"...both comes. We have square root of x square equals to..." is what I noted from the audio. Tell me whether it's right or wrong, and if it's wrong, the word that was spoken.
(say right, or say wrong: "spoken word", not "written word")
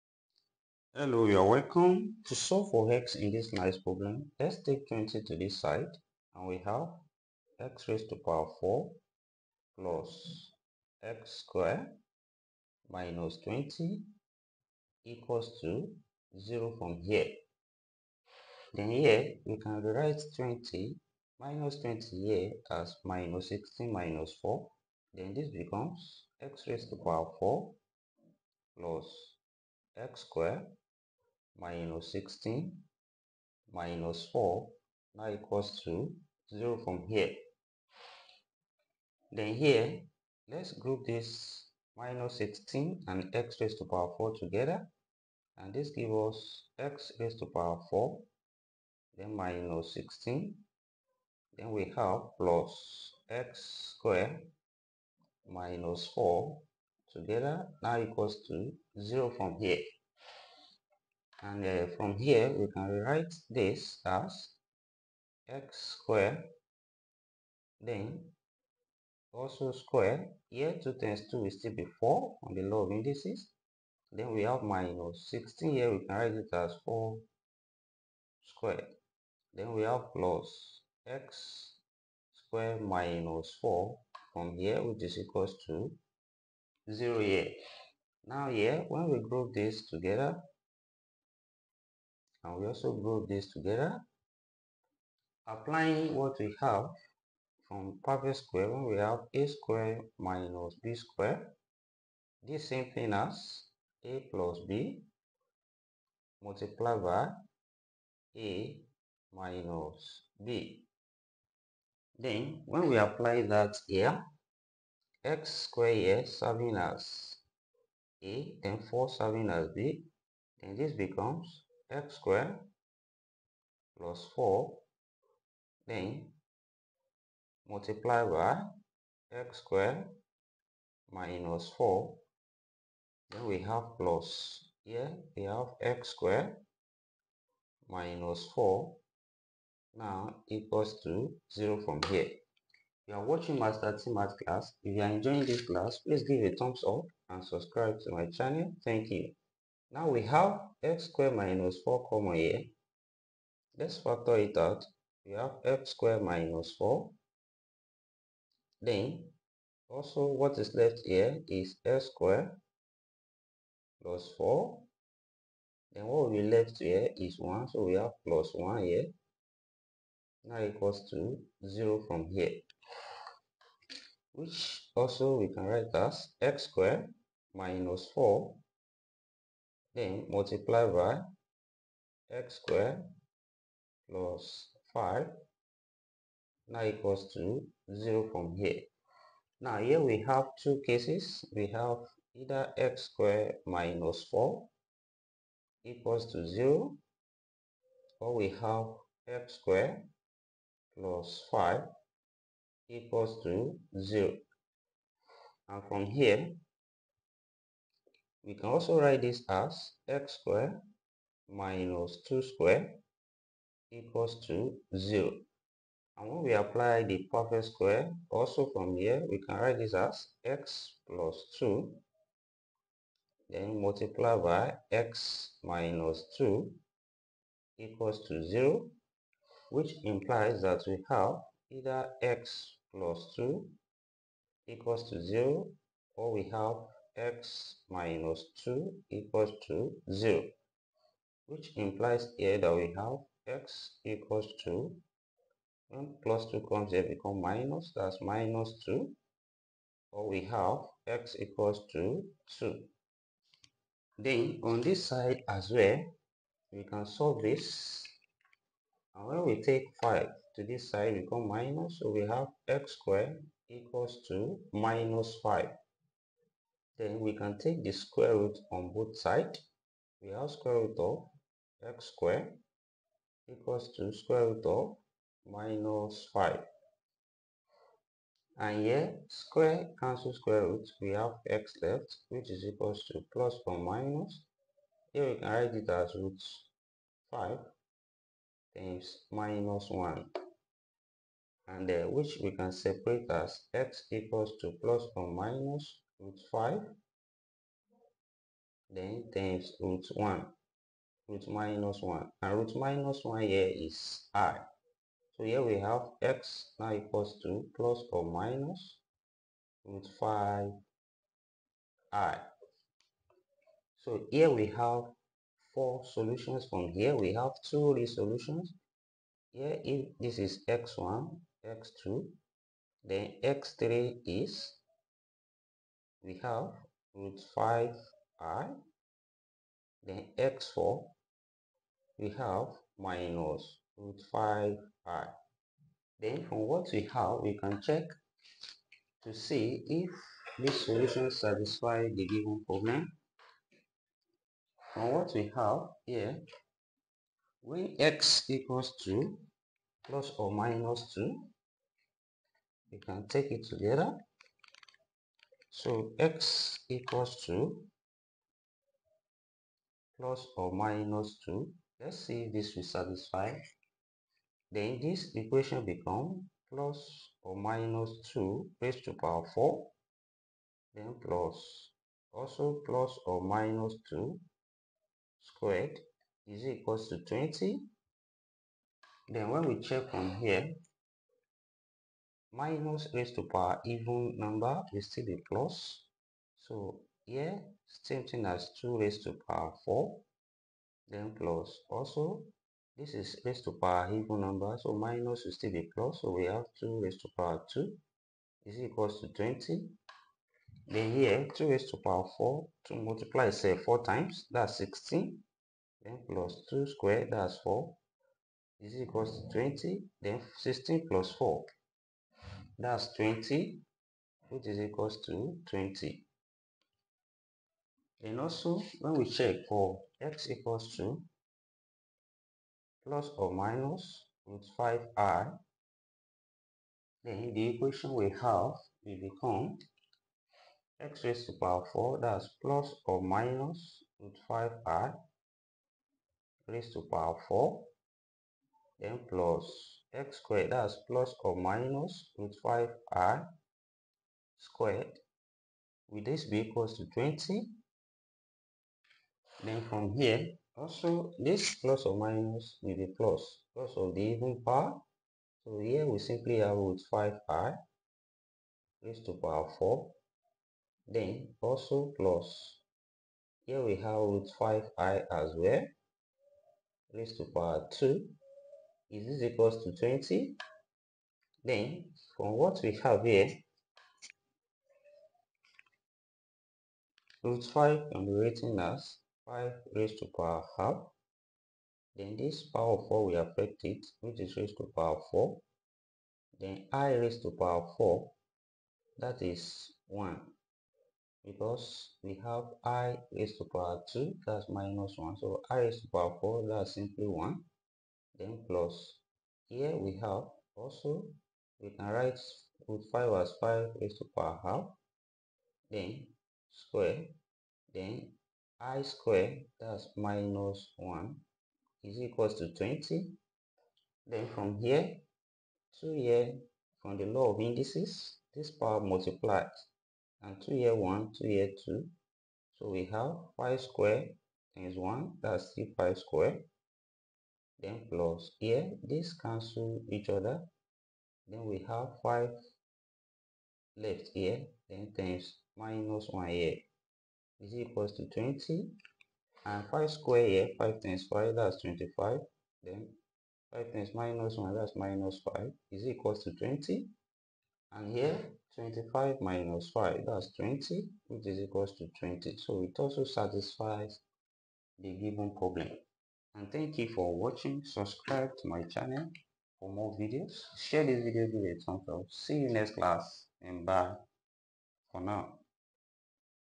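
wrong: "sides", not "comes".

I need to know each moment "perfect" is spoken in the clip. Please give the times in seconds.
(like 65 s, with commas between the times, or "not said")
98 s, 217 s.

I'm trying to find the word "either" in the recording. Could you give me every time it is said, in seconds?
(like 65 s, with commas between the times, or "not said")
192 s, 231 s.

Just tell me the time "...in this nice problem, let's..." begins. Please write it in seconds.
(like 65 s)
3 s.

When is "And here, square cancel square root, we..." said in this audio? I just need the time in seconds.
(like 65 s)
278 s.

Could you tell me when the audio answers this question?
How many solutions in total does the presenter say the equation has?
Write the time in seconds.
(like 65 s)
315 s.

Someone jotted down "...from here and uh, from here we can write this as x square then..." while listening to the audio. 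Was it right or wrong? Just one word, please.
wrong.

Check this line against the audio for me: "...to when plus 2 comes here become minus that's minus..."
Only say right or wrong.
right.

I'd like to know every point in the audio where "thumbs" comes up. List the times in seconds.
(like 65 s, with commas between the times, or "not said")
146 s, 561 s.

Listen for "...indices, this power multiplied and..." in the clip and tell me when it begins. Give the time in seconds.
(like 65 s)
517 s.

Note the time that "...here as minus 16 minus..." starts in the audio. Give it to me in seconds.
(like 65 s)
22 s.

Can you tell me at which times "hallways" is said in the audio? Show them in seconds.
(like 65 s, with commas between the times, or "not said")
not said.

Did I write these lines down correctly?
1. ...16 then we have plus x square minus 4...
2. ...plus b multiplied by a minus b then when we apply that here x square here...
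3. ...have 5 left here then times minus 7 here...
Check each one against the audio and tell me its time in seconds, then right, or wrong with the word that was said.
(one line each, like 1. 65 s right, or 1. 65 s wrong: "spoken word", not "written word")
1. 49 s right
2. 104 s right
3. 531 s wrong: "1", not "7".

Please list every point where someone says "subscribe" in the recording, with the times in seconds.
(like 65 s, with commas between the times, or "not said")
147 s, 557 s.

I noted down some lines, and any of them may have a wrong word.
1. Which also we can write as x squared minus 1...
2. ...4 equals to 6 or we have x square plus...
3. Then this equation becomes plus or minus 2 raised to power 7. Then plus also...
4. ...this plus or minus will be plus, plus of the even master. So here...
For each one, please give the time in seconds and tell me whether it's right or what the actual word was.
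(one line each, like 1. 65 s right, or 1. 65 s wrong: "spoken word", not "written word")
1. 174 s wrong: "4", not "1"
2. 194 s wrong: "0", not "6"
3. 364 s wrong: "4", not "7"
4. 451 s wrong: "power", not "master".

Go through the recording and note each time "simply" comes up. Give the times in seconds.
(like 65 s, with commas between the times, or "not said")
456 s, 496 s.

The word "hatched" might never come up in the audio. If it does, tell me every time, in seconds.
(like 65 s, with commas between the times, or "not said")
not said.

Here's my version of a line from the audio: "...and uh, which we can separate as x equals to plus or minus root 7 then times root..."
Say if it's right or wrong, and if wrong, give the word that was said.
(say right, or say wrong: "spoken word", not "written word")
wrong: "5", not "7".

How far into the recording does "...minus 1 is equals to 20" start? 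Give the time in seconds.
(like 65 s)
510 s.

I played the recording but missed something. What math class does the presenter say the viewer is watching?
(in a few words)
Master T math class.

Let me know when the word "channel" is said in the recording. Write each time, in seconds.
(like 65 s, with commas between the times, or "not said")
148 s, 558 s.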